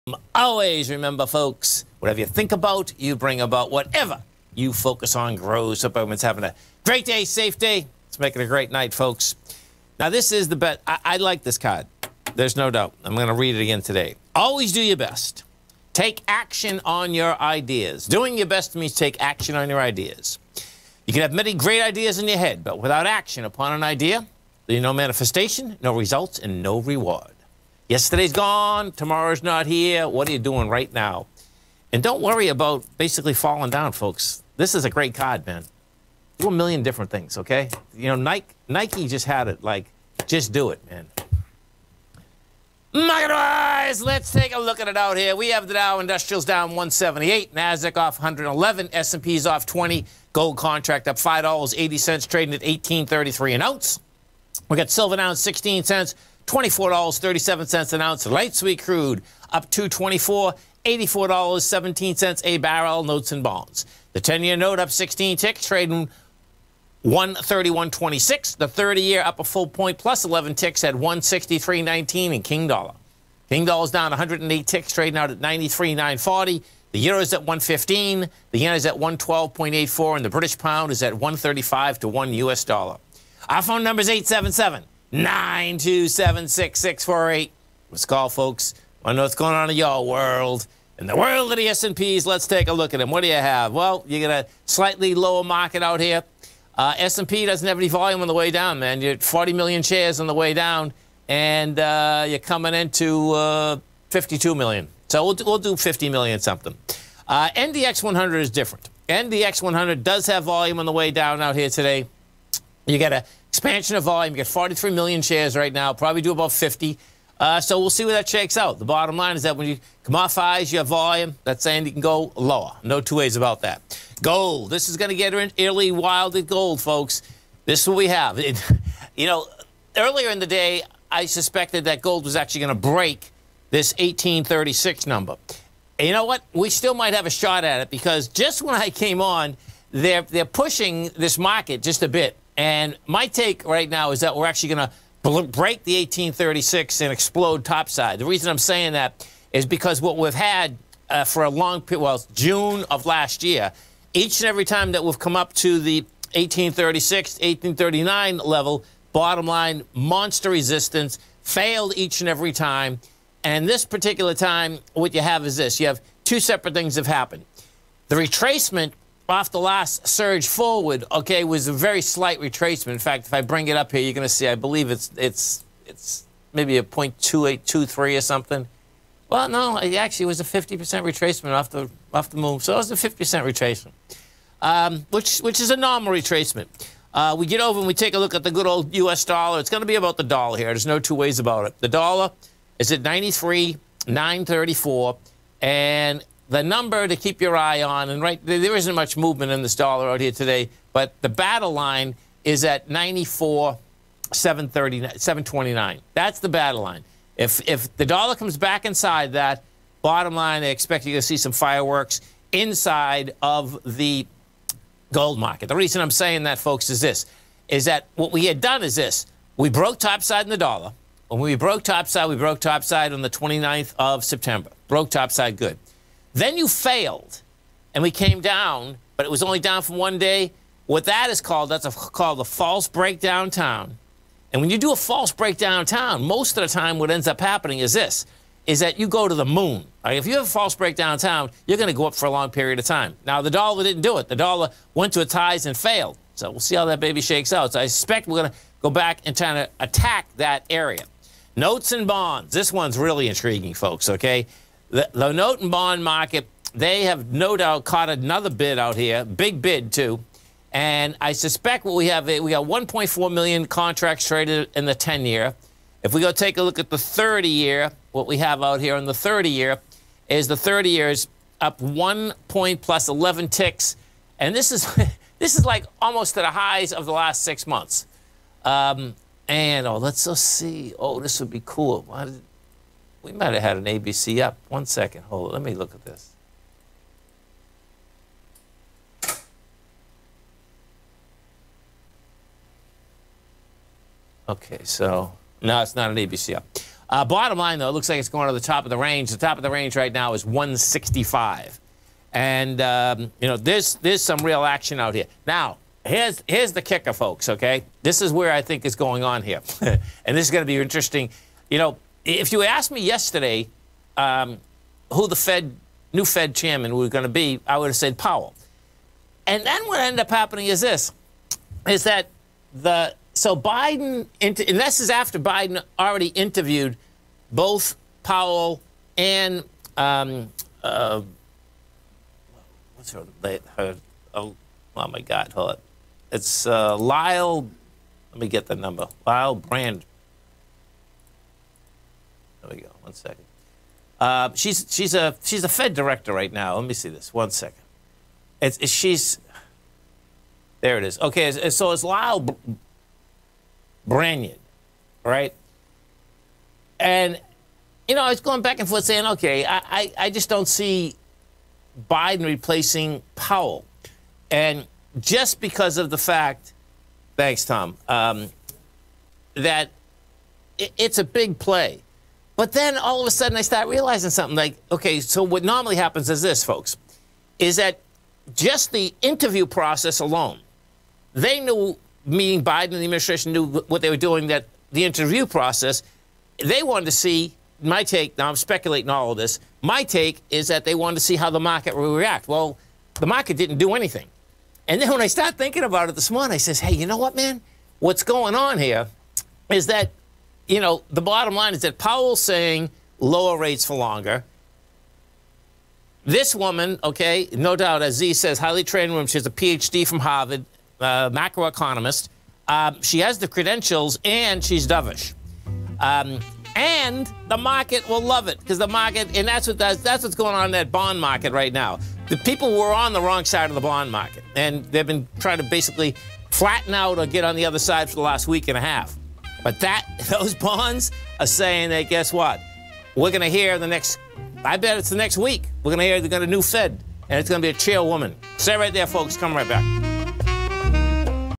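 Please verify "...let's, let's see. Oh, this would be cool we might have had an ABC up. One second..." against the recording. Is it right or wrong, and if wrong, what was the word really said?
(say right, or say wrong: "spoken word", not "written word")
right.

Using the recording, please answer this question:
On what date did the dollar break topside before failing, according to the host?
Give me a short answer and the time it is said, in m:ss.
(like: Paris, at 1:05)
September 29, at 3:43.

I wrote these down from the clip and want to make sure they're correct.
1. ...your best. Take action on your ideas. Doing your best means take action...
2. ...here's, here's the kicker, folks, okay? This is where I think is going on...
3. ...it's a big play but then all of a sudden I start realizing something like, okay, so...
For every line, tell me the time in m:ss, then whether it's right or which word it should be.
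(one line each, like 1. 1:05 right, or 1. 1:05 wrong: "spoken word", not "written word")
1. 0:14 right
2. 5:06 right
3. 6:10 right.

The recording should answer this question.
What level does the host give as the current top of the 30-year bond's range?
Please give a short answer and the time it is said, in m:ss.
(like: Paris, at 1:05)
165, at 5:00.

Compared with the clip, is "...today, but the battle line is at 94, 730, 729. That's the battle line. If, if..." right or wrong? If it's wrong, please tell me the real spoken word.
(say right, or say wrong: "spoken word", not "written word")
right.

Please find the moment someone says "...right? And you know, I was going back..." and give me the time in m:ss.
5:55.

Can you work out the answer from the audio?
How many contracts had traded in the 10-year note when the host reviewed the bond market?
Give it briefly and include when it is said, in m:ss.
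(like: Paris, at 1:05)
1.4 million, at 4:22.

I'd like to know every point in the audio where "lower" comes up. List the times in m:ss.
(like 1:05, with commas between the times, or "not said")
1:35, 2:02, 6:43.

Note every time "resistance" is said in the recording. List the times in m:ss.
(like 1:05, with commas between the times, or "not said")
2:40.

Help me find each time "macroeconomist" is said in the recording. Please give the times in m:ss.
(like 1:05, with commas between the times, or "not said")
6:51.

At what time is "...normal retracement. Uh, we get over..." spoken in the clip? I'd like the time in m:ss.
3:05.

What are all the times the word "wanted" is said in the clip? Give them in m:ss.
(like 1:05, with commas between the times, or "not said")
6:26, 6:30.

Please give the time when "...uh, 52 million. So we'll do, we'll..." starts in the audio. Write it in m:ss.
1:43.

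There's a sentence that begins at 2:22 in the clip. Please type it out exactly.
And my take right now is that we're actually going to break the 1836 and explode topside.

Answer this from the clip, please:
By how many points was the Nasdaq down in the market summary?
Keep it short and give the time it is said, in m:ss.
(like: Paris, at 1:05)
111, at 0:47.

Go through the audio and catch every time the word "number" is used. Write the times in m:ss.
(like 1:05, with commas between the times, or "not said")
2:15, 3:16, 5:38.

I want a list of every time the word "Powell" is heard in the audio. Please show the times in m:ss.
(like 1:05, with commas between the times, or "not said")
5:18, 5:28, 6:03, 6:41.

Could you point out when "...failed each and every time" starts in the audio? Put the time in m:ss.
2:41.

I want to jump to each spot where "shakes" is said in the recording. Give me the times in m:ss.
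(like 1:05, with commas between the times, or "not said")
1:58, 4:07.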